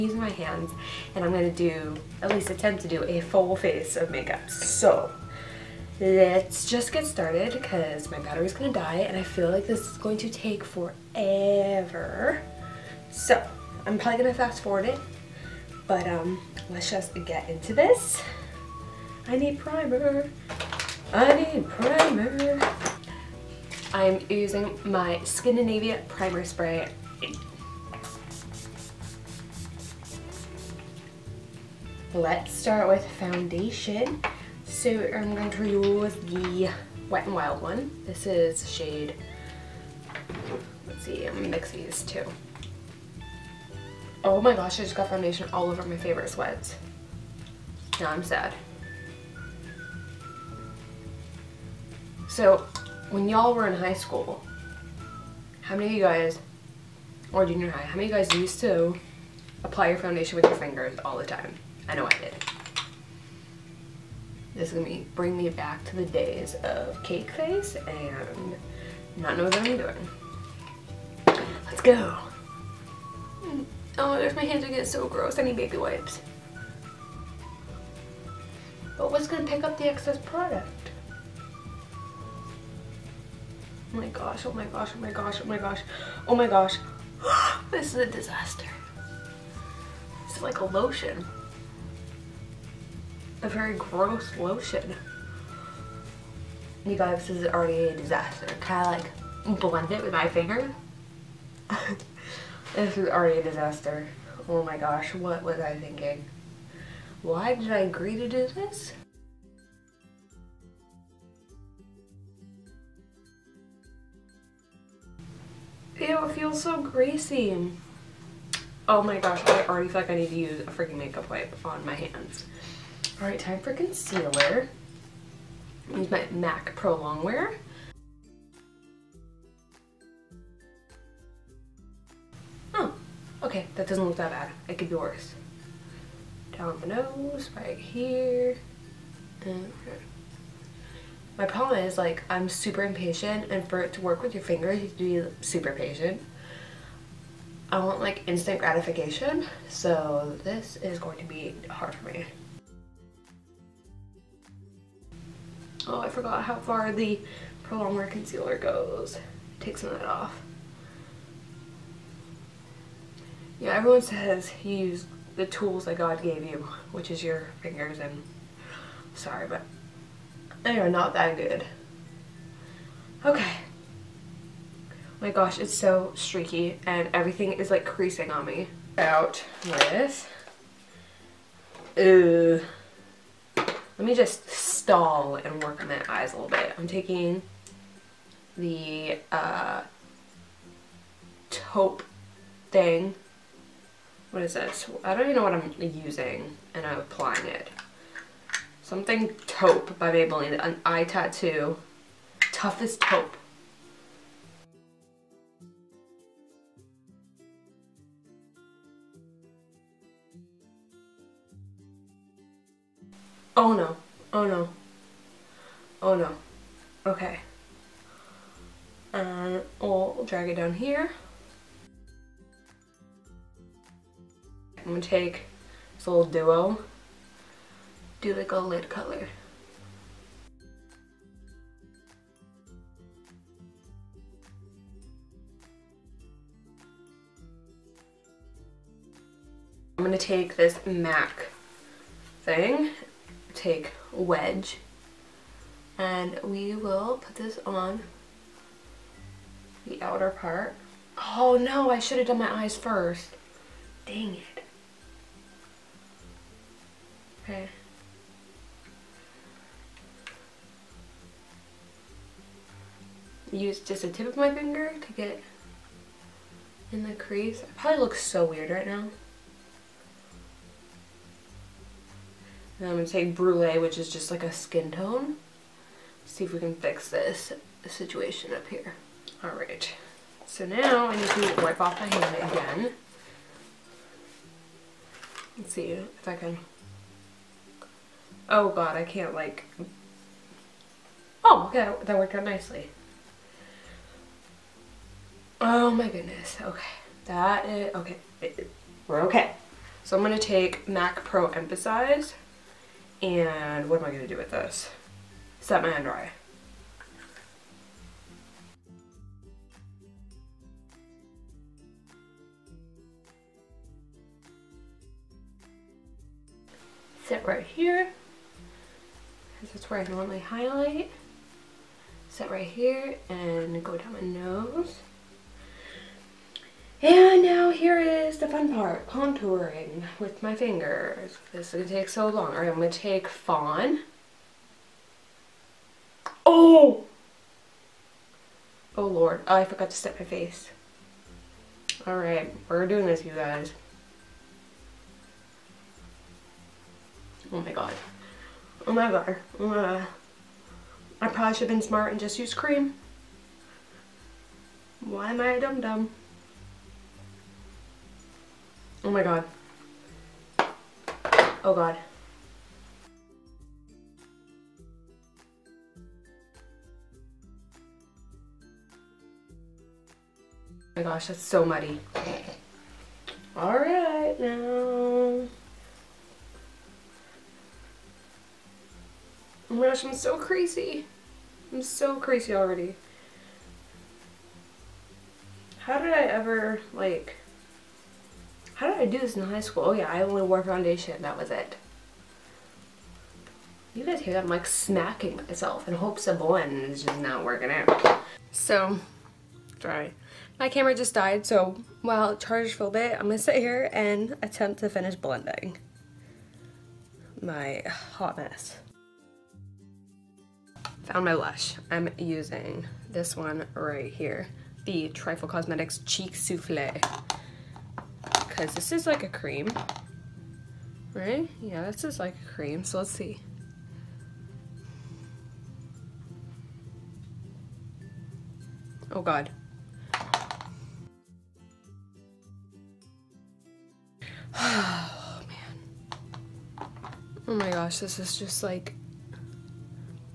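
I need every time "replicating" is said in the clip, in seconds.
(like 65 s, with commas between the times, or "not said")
not said.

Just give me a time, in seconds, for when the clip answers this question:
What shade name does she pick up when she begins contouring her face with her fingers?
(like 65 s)
333 s.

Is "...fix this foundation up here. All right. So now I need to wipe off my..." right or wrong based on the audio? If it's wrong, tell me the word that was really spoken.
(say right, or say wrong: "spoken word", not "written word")
wrong: "situation", not "foundation".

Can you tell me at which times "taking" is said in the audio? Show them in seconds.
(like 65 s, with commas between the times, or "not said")
186 s.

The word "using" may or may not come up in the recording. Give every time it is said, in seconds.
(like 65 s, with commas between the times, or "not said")
0 s, 24 s, 195 s, 412 s.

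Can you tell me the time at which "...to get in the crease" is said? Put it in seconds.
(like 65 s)
265 s.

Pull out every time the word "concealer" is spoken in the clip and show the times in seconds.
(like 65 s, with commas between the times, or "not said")
123 s, 158 s.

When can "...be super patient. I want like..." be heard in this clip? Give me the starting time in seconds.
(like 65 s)
145 s.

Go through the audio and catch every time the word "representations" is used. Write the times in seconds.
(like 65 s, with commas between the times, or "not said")
not said.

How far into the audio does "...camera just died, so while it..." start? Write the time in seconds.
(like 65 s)
400 s.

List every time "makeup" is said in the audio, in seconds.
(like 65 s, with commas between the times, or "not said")
4 s, 120 s.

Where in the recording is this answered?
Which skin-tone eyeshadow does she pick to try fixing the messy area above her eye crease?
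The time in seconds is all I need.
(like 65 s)
273 s.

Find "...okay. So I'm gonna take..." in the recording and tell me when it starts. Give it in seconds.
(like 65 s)
299 s.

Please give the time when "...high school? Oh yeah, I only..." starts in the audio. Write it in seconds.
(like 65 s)
389 s.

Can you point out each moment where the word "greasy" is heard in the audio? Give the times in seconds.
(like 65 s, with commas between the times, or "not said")
116 s.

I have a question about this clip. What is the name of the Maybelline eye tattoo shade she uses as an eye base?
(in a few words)
Tough as Taupe.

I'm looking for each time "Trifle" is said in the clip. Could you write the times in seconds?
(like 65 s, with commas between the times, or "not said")
415 s.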